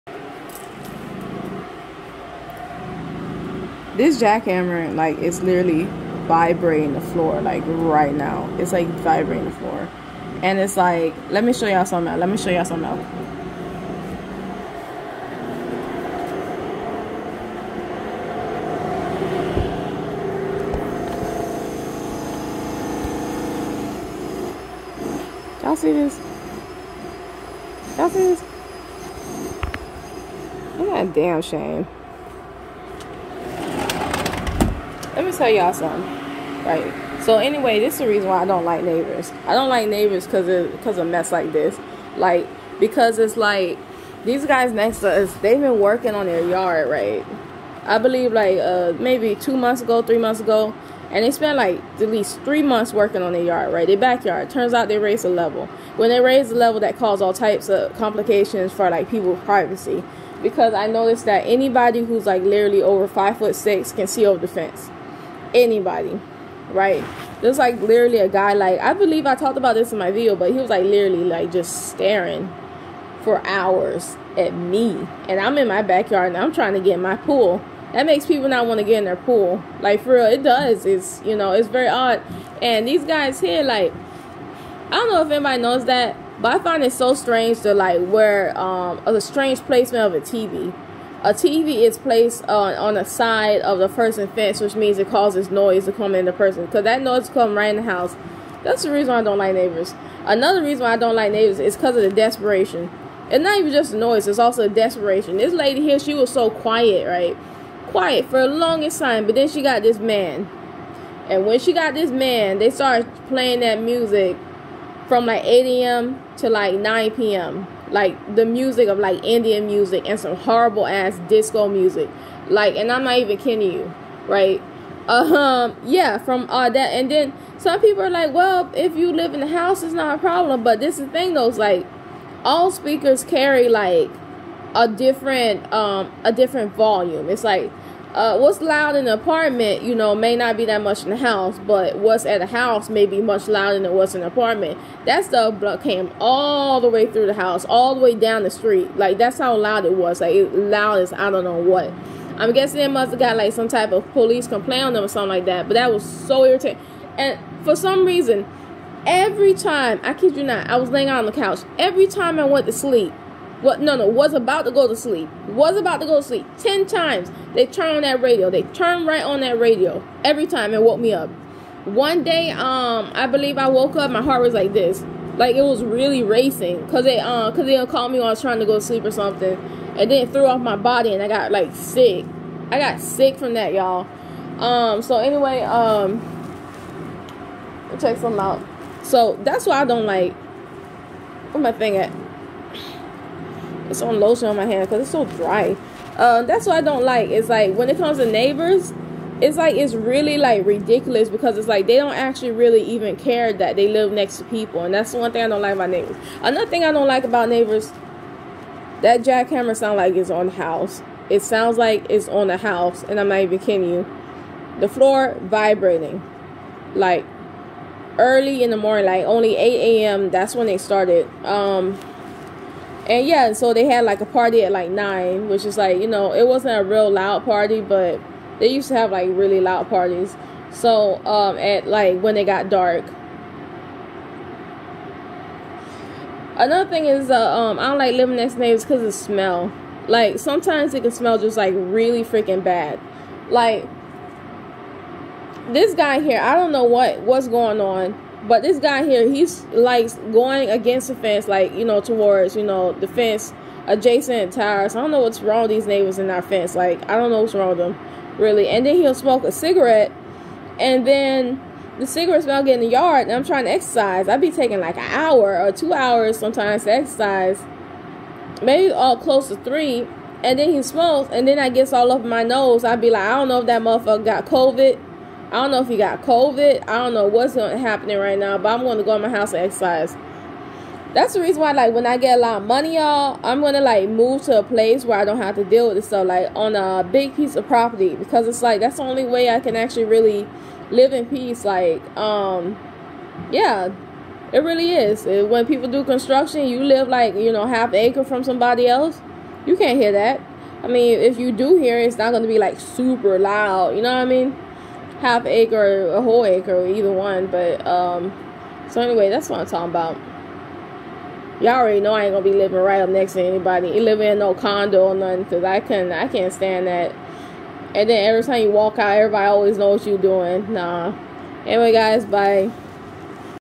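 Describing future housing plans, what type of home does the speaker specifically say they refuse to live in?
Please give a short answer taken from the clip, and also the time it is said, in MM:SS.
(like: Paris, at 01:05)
condo, at 05:14.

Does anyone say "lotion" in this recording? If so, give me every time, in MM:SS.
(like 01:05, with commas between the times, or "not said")
03:14.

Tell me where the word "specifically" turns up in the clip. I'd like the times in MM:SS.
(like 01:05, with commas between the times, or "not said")
not said.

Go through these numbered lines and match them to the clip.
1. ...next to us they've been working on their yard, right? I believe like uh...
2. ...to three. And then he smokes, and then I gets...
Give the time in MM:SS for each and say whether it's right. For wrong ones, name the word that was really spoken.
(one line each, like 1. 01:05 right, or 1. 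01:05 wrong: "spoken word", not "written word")
1. 00:44 right
2. 04:29 right.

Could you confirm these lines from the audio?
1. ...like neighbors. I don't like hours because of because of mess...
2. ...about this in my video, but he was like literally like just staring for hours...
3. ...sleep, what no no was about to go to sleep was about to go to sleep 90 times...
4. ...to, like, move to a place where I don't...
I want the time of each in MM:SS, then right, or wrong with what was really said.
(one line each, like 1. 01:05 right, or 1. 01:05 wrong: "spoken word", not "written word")
1. 00:38 wrong: "neighbors", not "hours"
2. 01:09 right
3. 02:42 wrong: "10", not "90"
4. 04:43 right.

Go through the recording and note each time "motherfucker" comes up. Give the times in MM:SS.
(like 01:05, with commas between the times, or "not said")
04:33.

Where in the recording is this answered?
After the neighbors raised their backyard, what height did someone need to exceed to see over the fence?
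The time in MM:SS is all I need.
01:03.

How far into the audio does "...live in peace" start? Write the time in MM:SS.
04:50.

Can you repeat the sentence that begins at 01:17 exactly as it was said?
That makes people not want to get in their pool.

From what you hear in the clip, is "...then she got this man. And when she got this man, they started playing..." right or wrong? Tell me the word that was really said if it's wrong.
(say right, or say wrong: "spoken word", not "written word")
right.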